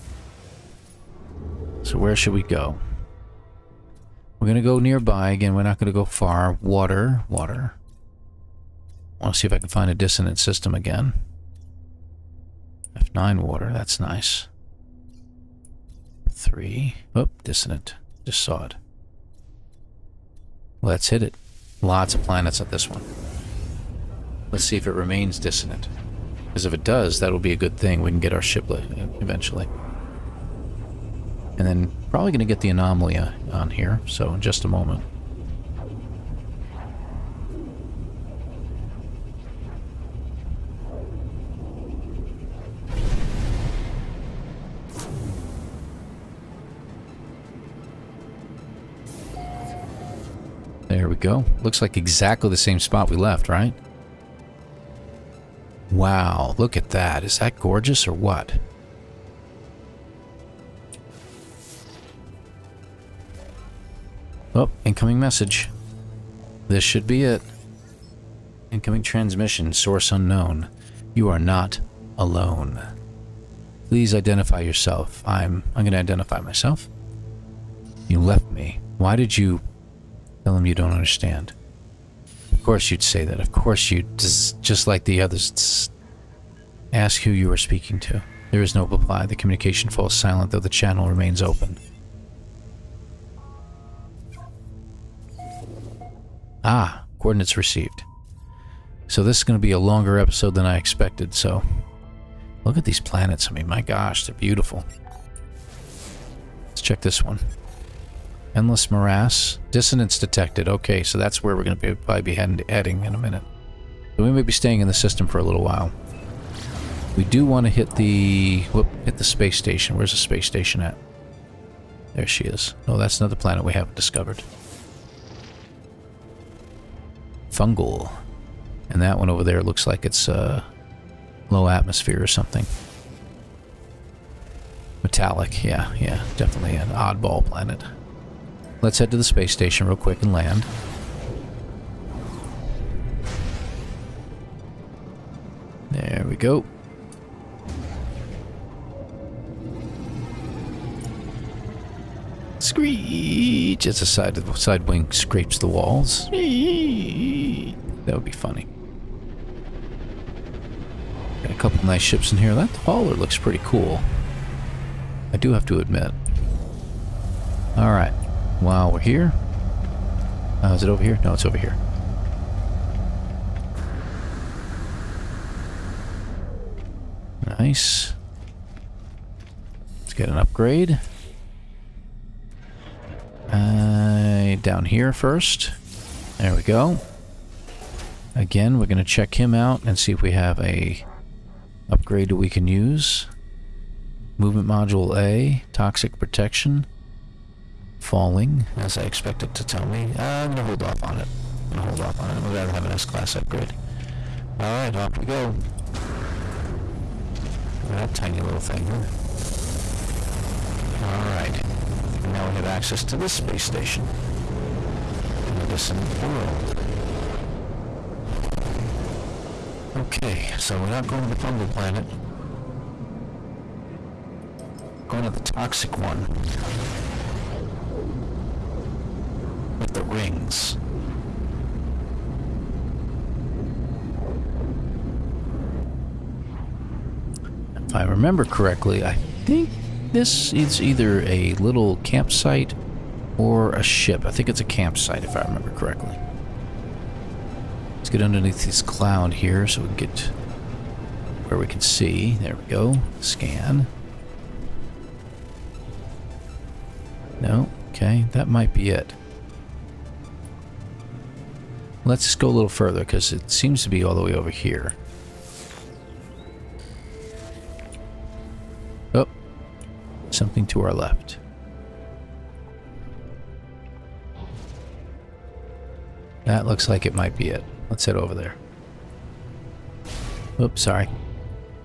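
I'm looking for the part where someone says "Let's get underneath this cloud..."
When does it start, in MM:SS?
04:07.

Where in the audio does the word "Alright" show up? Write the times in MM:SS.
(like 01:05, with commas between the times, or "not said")
02:47, 03:24, 03:31.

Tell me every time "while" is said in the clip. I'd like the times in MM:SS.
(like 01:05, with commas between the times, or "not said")
01:55, 02:48.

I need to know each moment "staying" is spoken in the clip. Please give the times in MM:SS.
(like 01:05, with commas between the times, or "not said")
01:54.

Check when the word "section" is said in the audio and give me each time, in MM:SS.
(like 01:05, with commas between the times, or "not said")
not said.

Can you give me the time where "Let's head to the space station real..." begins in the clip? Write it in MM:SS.
02:18.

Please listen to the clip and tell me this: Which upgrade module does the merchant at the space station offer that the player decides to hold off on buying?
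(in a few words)
Movement Module A.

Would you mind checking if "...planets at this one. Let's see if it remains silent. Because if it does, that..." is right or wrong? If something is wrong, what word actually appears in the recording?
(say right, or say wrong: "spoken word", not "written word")
wrong: "dissonant", not "silent".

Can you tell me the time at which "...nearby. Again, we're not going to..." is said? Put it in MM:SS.
00:04.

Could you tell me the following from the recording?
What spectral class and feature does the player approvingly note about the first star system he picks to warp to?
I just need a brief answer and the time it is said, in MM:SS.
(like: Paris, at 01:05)
F9 water, at 00:12.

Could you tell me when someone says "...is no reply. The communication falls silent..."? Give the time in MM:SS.
01:28.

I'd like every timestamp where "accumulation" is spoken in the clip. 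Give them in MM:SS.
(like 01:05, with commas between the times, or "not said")
not said.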